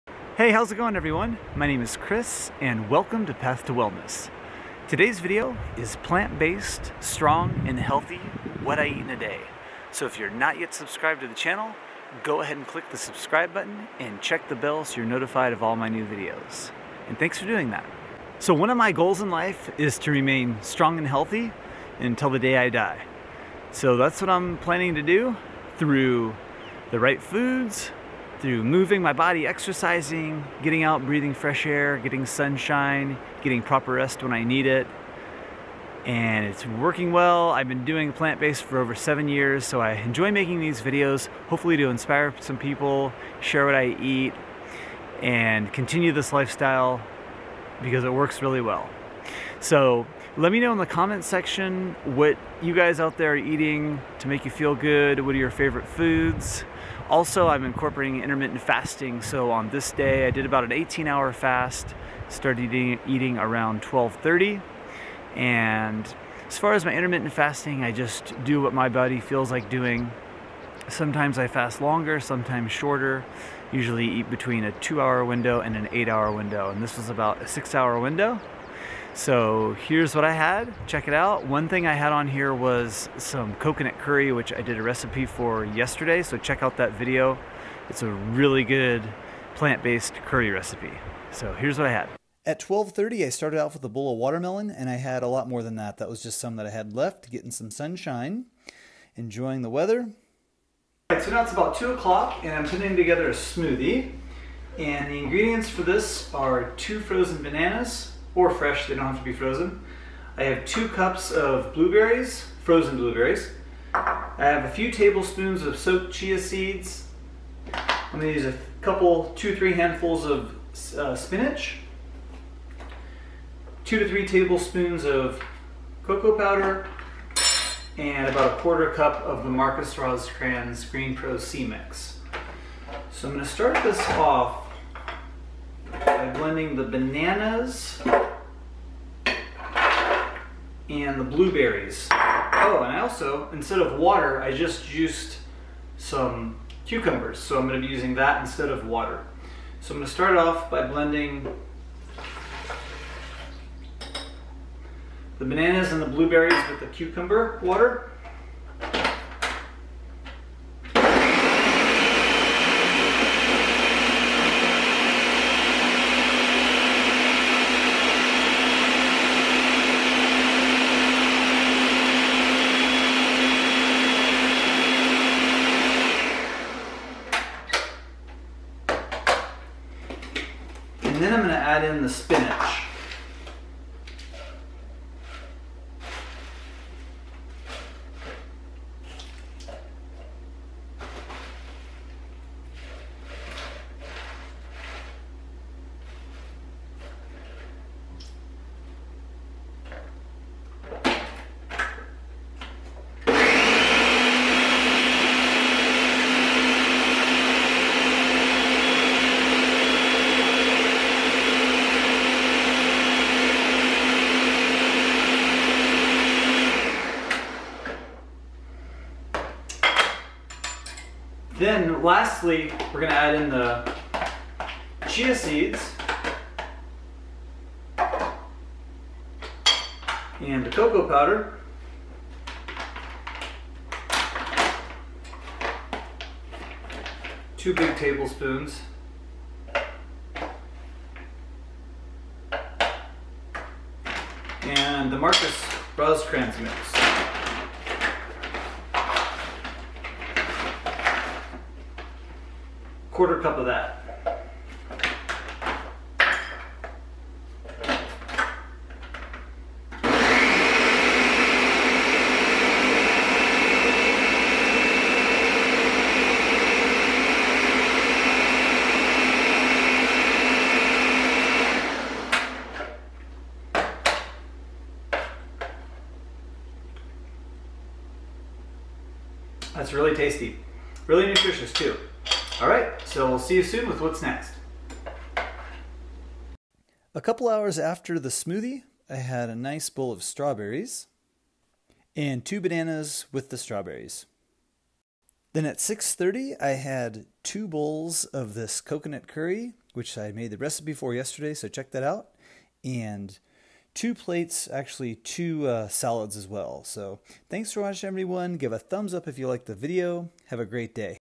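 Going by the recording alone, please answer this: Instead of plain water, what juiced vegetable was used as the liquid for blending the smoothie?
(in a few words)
cucumbers.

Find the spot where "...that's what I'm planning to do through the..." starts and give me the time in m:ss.
0:23.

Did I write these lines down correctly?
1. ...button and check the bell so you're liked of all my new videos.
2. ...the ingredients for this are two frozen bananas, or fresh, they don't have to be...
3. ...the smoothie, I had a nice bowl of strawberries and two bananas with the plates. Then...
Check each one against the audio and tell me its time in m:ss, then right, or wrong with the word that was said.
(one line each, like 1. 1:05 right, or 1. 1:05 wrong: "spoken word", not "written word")
1. 0:13 wrong: "notified", not "liked"
2. 1:45 right
3. 4:48 wrong: "strawberries", not "plates".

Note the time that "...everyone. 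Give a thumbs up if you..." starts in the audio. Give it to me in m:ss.
5:08.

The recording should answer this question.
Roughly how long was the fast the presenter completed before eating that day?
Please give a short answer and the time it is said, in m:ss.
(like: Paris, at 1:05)
18 hour, at 1:00.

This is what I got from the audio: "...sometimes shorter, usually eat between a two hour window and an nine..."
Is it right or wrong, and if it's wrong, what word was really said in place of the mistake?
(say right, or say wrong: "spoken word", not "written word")
wrong: "eight", not "nine".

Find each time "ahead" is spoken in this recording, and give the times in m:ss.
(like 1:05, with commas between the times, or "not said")
0:12.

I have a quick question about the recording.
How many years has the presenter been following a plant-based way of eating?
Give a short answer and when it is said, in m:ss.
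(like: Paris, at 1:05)
over 7 years, at 0:38.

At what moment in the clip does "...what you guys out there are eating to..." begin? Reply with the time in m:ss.
0:52.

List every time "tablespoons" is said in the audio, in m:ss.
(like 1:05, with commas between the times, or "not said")
1:54, 2:04, 3:57.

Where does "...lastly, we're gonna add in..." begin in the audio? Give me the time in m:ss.
3:42.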